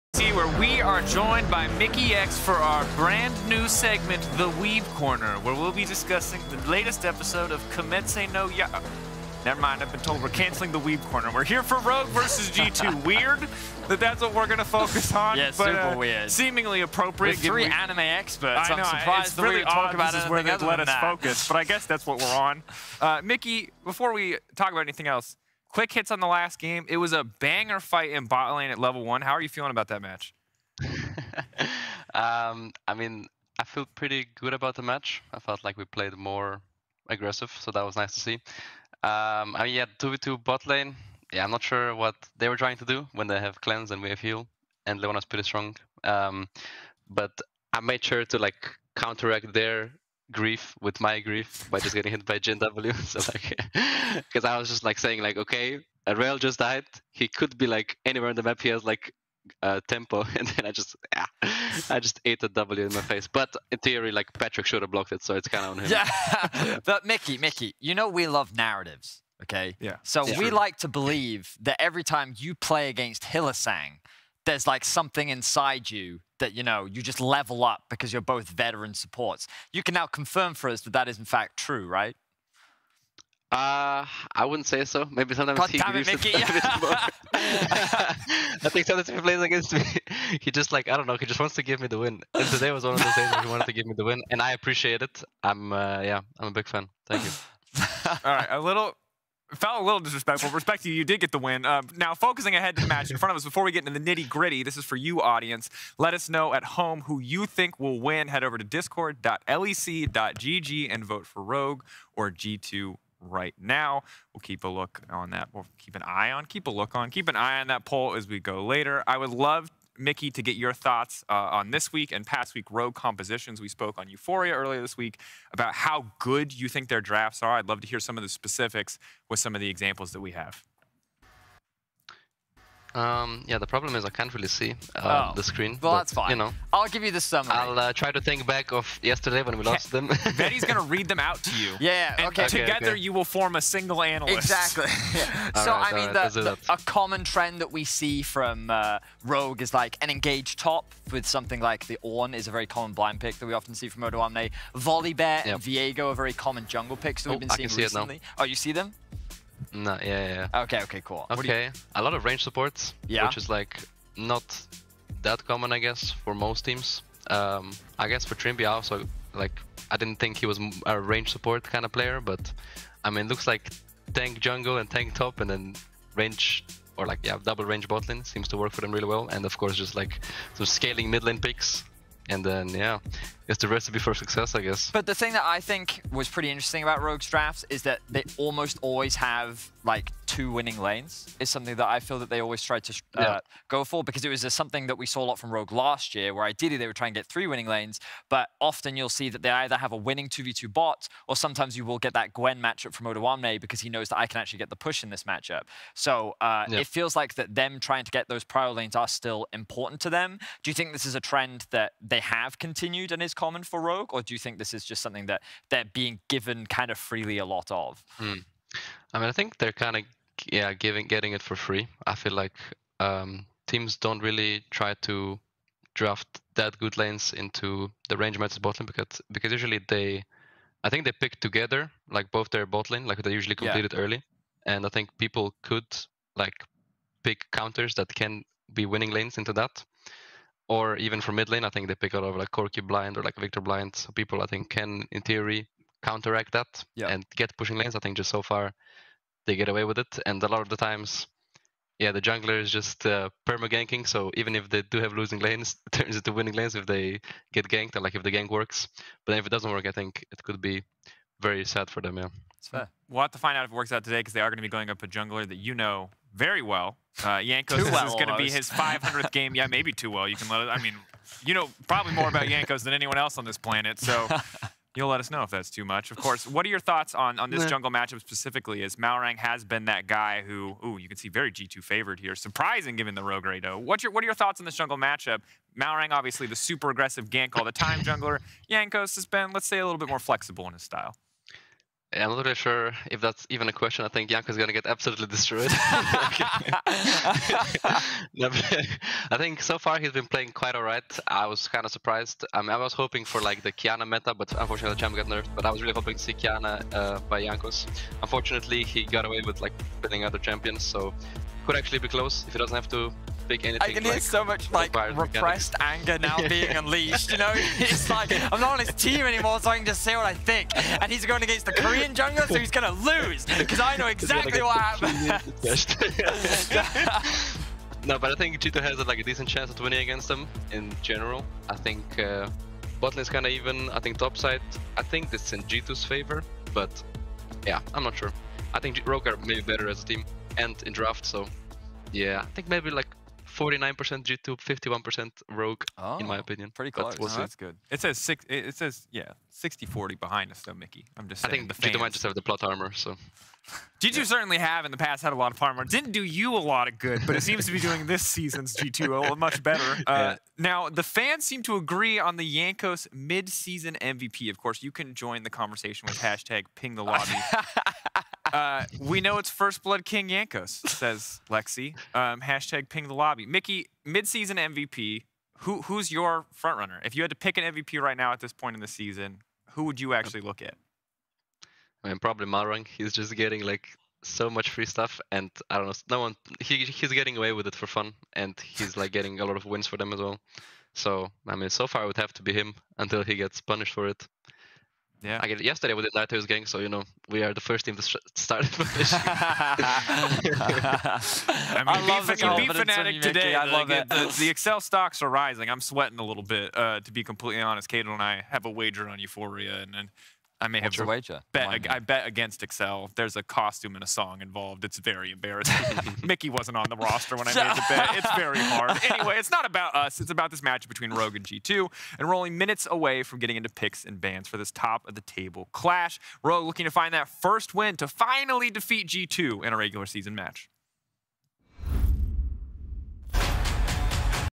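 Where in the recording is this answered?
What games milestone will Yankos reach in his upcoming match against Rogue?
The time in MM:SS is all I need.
04:28.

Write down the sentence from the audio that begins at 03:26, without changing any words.
it feels like that them trying to get those prior lanes are still important to them.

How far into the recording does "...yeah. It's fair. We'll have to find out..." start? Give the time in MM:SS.
04:22.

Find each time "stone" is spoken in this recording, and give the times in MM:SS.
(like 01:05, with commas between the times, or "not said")
not said.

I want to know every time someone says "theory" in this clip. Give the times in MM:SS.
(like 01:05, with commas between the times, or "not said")
01:03, 04:05.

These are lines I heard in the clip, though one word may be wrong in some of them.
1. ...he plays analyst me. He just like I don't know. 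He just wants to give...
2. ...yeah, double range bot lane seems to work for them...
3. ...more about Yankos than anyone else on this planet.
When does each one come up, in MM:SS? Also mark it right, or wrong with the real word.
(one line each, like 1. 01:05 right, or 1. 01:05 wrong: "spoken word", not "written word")
1. 01:29 wrong: "against", not "analyst"
2. 02:57 right
3. 04:32 right.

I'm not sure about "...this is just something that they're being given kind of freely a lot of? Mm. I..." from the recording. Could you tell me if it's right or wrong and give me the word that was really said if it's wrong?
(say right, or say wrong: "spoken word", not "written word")
right.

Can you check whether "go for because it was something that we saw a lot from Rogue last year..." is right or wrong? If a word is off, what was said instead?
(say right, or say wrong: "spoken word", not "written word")
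right.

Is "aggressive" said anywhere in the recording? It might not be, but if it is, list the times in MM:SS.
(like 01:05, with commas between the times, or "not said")
00:37, 04:46.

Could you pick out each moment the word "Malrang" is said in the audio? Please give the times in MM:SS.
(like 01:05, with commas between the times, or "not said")
04:38, 04:45, 06:22.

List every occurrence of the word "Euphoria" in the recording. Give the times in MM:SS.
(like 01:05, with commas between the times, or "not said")
02:04, 06:49.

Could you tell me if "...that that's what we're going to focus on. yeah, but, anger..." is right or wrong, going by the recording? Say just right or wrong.
wrong.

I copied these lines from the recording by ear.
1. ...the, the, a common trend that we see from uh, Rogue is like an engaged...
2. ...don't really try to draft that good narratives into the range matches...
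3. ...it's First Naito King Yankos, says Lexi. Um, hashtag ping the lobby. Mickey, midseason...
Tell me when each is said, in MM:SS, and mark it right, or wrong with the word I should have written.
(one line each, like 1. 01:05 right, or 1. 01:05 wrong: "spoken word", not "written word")
1. 02:26 right
2. 03:44 wrong: "lanes", not "narratives"
3. 06:09 wrong: "Blood", not "Naito".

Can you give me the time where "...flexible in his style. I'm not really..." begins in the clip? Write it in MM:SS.
04:50.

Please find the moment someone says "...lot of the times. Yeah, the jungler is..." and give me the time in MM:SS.
04:10.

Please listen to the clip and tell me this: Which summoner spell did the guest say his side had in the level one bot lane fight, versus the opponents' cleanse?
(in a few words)
Heal.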